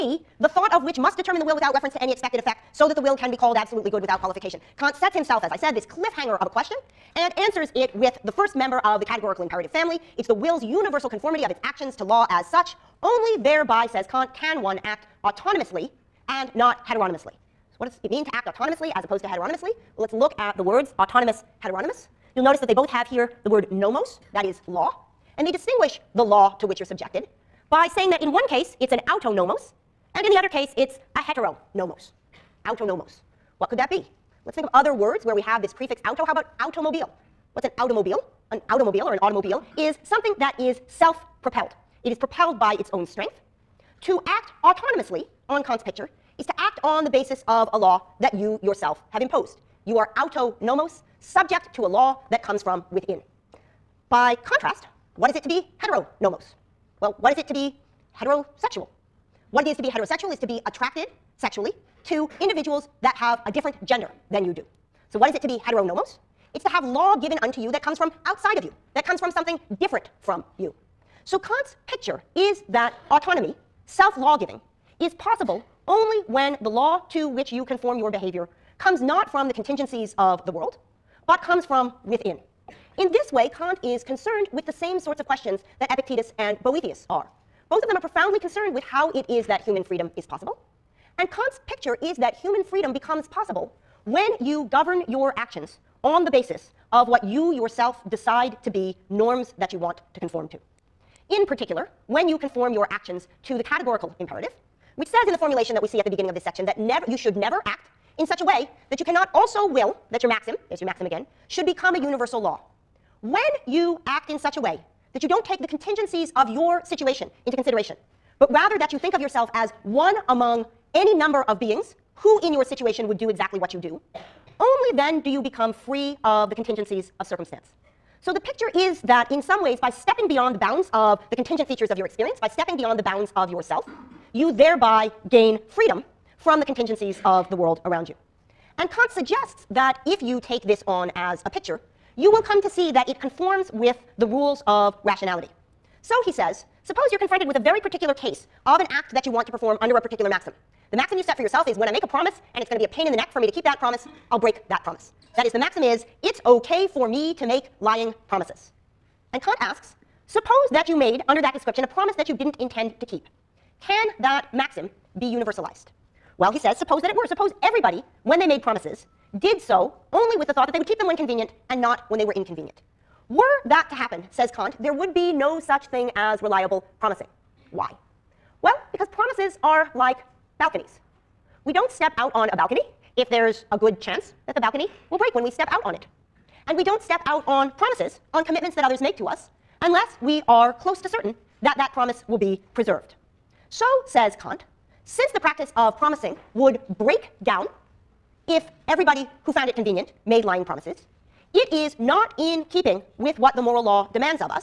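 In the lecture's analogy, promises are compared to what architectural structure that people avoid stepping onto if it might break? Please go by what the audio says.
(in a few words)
balconies.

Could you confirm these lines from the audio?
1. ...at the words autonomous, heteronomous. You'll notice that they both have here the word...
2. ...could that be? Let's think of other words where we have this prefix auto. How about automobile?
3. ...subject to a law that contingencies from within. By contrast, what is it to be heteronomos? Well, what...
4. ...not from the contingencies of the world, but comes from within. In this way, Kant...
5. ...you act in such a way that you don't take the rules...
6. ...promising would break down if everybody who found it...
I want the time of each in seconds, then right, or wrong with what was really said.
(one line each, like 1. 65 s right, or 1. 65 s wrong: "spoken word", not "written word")
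1. 20 s right
2. 33 s right
3. 51 s wrong: "comes", not "contingencies"
4. 79 s right
5. 113 s wrong: "contingencies", not "rules"
6. 195 s right.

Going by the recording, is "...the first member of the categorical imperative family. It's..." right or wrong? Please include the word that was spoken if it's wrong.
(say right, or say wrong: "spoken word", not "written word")
right.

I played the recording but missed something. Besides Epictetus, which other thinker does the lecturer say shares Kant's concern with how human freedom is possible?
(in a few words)
Boethius.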